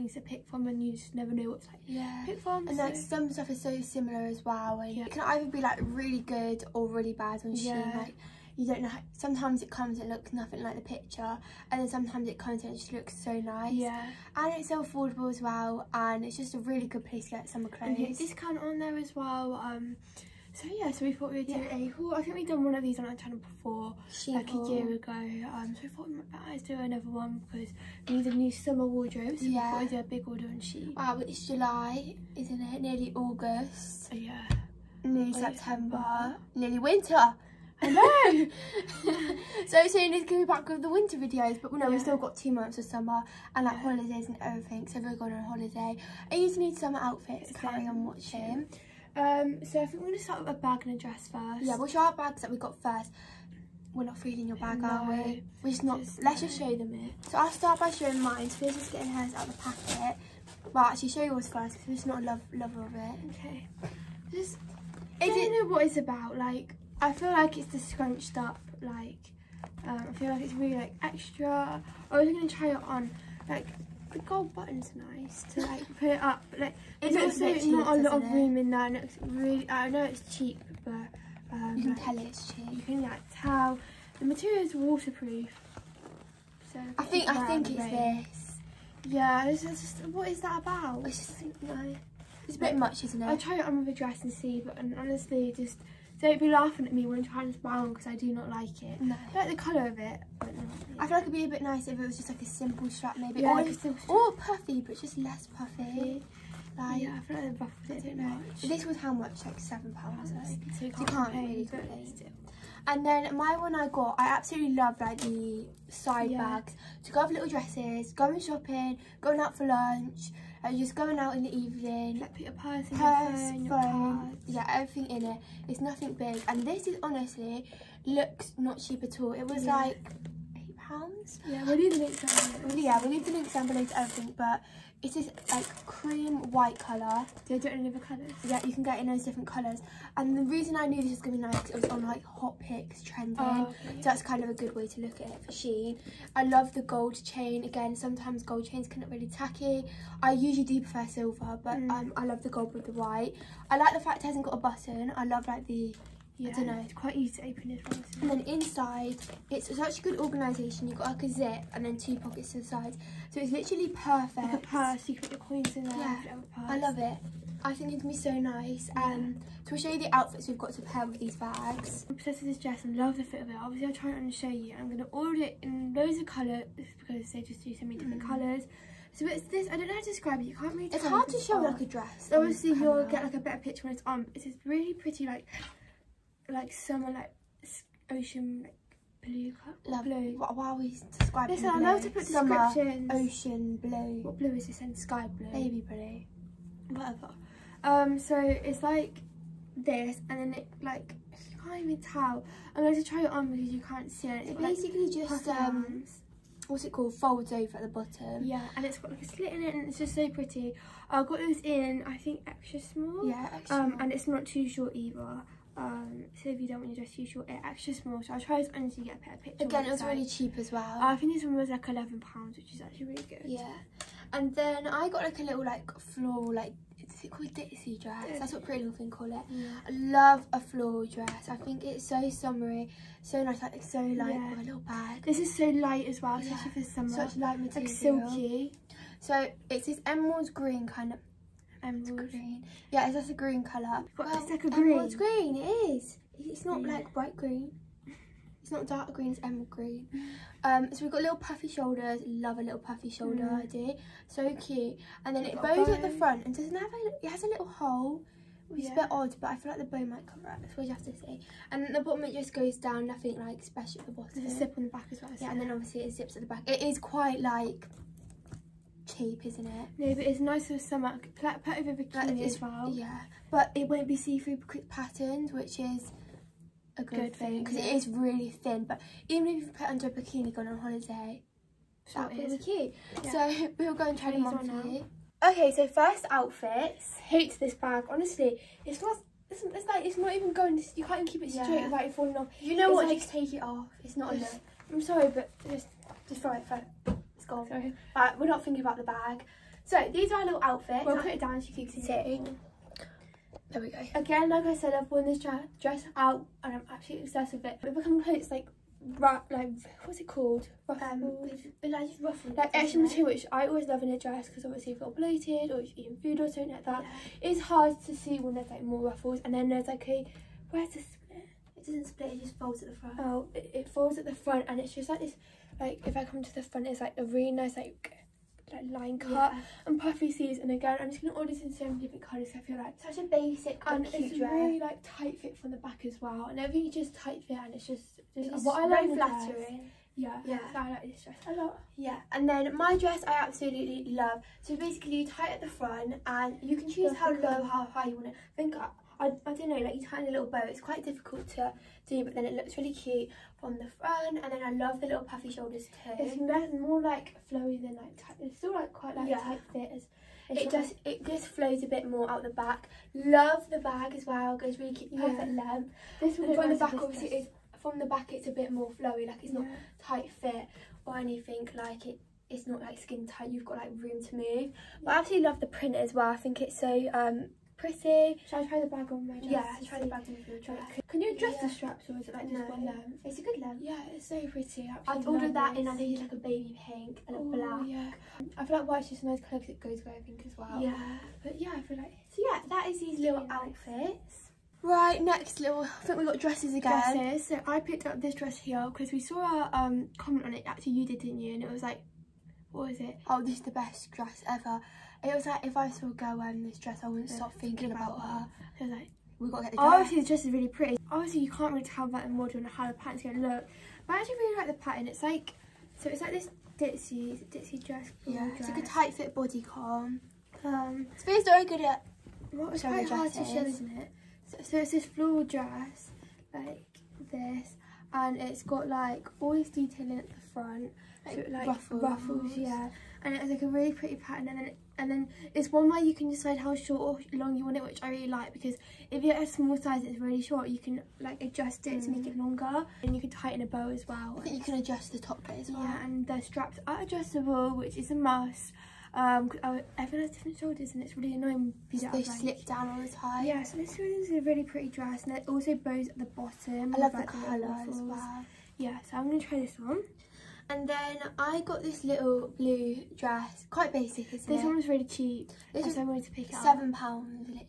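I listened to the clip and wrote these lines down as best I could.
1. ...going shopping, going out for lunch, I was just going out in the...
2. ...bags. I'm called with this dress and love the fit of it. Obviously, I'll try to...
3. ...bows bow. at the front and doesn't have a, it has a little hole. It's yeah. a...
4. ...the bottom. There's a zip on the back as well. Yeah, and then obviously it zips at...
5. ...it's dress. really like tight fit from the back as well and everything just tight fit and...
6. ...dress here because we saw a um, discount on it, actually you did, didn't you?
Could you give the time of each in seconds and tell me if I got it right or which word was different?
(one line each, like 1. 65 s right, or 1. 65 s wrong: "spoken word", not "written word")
1. 118 s right
2. 171 s wrong: "obsessed", not "called"
3. 255 s right
4. 264 s right
5. 334 s right
6. 398 s wrong: "comment", not "discount".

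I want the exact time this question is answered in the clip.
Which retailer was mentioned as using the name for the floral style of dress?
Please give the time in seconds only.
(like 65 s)
228 s.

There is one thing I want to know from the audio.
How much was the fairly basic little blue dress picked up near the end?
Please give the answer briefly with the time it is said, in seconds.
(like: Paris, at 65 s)
£7, at 466 s.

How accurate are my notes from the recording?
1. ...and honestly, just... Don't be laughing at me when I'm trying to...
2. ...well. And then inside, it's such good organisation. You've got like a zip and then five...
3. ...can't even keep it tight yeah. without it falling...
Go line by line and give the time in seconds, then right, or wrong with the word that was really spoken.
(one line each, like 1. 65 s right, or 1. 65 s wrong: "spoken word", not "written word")
1. 94 s right
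2. 157 s wrong: "two", not "five"
3. 291 s wrong: "straight", not "tight".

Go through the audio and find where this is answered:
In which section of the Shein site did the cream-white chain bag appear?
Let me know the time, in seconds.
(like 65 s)
142 s.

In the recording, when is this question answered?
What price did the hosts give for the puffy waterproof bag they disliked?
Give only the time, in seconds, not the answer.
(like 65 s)
109 s.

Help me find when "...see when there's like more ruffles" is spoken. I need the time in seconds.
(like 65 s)
318 s.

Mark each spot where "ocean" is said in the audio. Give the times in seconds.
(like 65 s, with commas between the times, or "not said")
188 s, 193 s.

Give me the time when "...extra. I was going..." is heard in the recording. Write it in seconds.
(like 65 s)
71 s.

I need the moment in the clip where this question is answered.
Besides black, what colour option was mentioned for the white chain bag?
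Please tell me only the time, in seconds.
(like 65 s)
386 s.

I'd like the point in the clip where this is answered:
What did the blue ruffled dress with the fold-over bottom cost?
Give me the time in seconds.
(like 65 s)
221 s.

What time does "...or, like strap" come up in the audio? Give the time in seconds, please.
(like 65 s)
103 s.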